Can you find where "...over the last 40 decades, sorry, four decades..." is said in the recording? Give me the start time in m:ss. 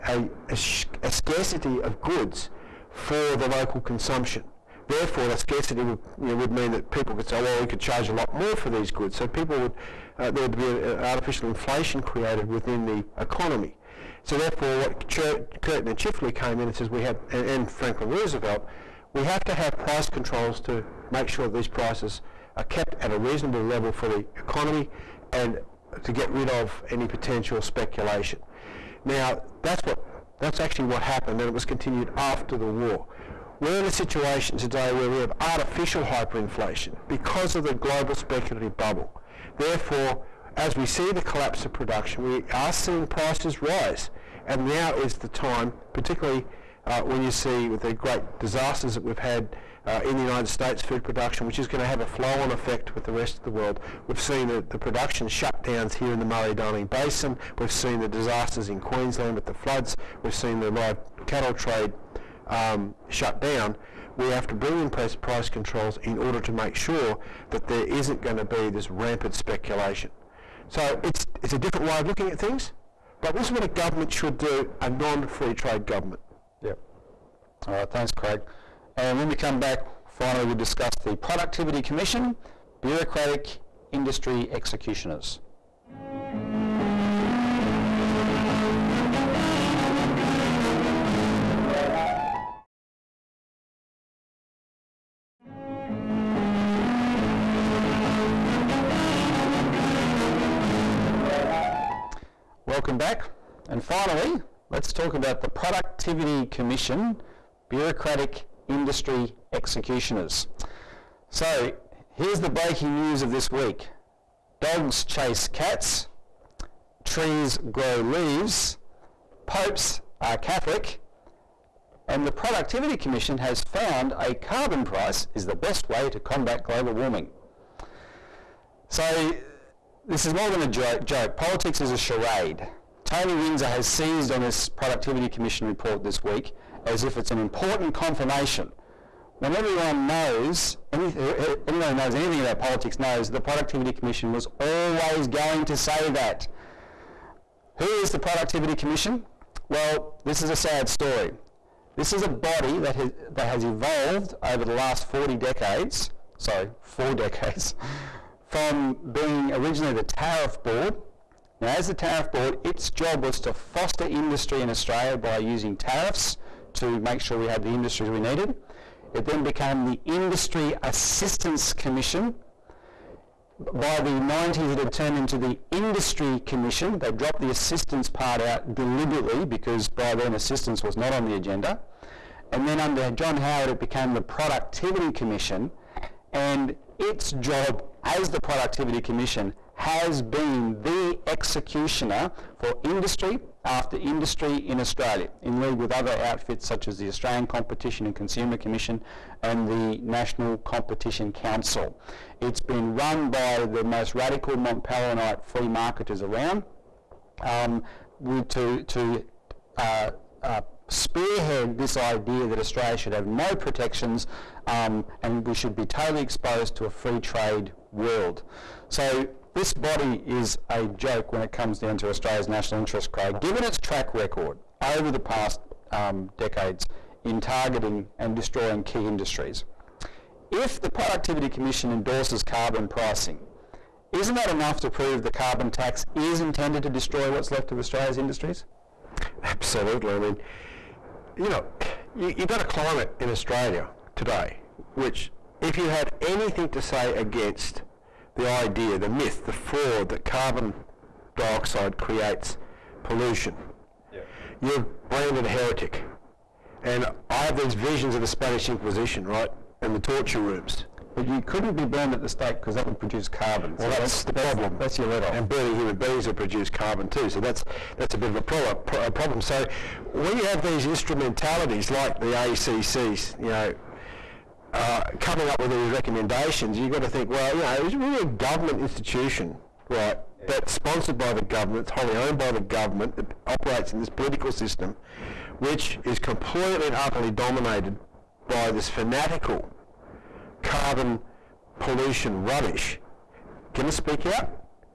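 2:34.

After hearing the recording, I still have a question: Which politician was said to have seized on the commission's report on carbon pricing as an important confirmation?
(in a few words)
Tony Windsor.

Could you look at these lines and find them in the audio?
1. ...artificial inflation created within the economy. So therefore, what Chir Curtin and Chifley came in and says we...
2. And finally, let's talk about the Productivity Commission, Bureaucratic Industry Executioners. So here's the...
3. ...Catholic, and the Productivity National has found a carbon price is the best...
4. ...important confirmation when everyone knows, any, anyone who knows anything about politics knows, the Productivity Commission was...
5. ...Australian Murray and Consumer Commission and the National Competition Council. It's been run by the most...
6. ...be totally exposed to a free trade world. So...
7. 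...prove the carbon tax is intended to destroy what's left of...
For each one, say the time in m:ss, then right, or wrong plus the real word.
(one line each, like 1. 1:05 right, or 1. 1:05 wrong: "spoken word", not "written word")
1. 0:10 right
2. 1:43 right
3. 2:00 wrong: "Commission", not "National"
4. 2:17 right
5. 3:17 wrong: "Competition", not "Murray"
6. 3:35 right
7. 3:54 right.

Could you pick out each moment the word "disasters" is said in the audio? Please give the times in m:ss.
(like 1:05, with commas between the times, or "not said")
0:48, 0:58.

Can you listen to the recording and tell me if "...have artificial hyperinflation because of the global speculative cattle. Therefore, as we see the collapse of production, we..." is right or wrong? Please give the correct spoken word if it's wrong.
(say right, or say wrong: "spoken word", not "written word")
wrong: "bubble", not "cattle".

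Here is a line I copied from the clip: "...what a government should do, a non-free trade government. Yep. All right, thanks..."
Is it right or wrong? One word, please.
right.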